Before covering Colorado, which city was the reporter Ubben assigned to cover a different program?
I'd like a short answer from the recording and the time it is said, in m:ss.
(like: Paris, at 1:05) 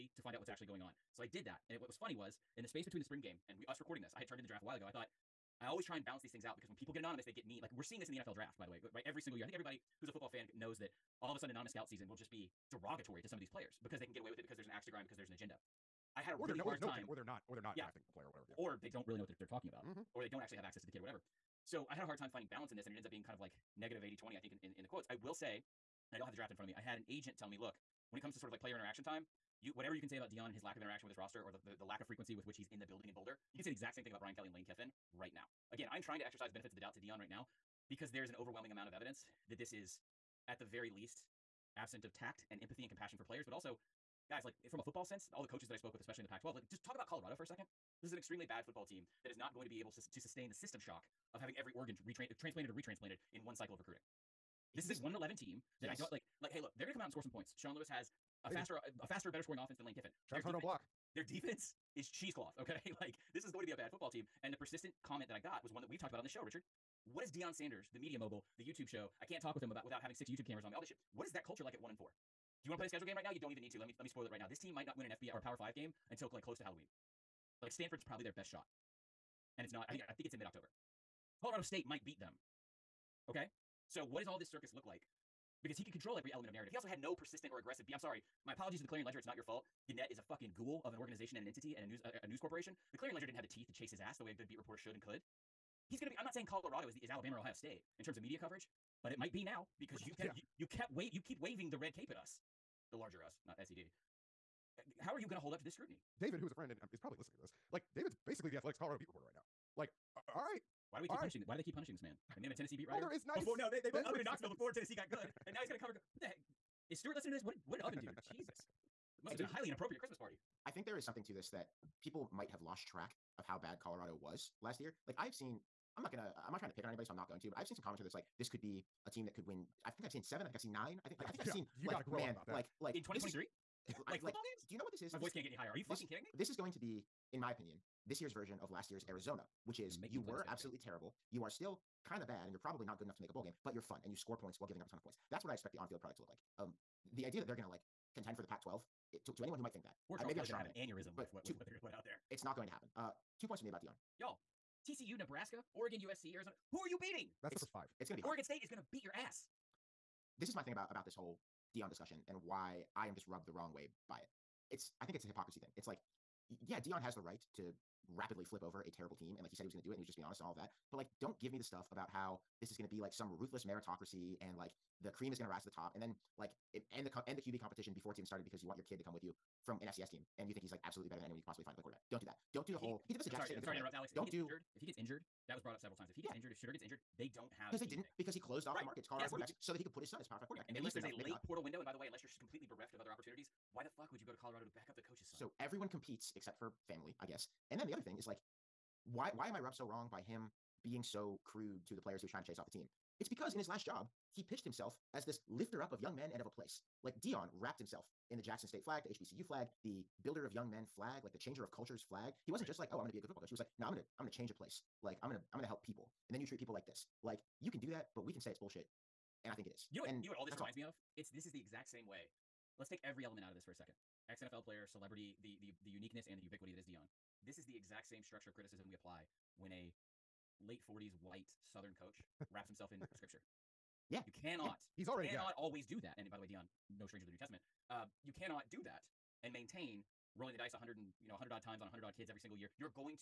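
Knoxville, at 1:54.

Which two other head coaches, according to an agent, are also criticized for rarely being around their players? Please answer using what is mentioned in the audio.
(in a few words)
Brian Kelly and Lane Kiffin.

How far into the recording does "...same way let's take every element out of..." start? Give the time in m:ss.
3:41.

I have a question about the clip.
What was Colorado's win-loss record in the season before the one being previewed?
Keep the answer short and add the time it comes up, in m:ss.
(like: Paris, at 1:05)
1-11, at 0:55.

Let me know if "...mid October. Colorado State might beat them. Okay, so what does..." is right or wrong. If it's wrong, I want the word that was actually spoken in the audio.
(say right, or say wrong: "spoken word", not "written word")
right.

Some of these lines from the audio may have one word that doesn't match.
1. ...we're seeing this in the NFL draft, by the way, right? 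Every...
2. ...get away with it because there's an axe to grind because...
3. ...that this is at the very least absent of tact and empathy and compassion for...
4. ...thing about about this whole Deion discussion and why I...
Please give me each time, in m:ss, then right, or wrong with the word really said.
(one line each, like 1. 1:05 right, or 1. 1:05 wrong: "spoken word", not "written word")
1. 0:07 right
2. 0:14 right
3. 0:39 right
4. 2:40 right.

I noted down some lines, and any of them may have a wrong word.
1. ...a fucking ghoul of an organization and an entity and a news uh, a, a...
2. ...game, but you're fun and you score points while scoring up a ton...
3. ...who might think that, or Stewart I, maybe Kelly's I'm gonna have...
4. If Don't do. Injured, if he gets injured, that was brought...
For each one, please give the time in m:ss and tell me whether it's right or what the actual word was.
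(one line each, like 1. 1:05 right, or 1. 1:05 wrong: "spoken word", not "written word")
1. 1:30 right
2. 2:23 wrong: "giving", not "scoring"
3. 2:29 wrong: "Charles", not "Stewart"
4. 3:04 right.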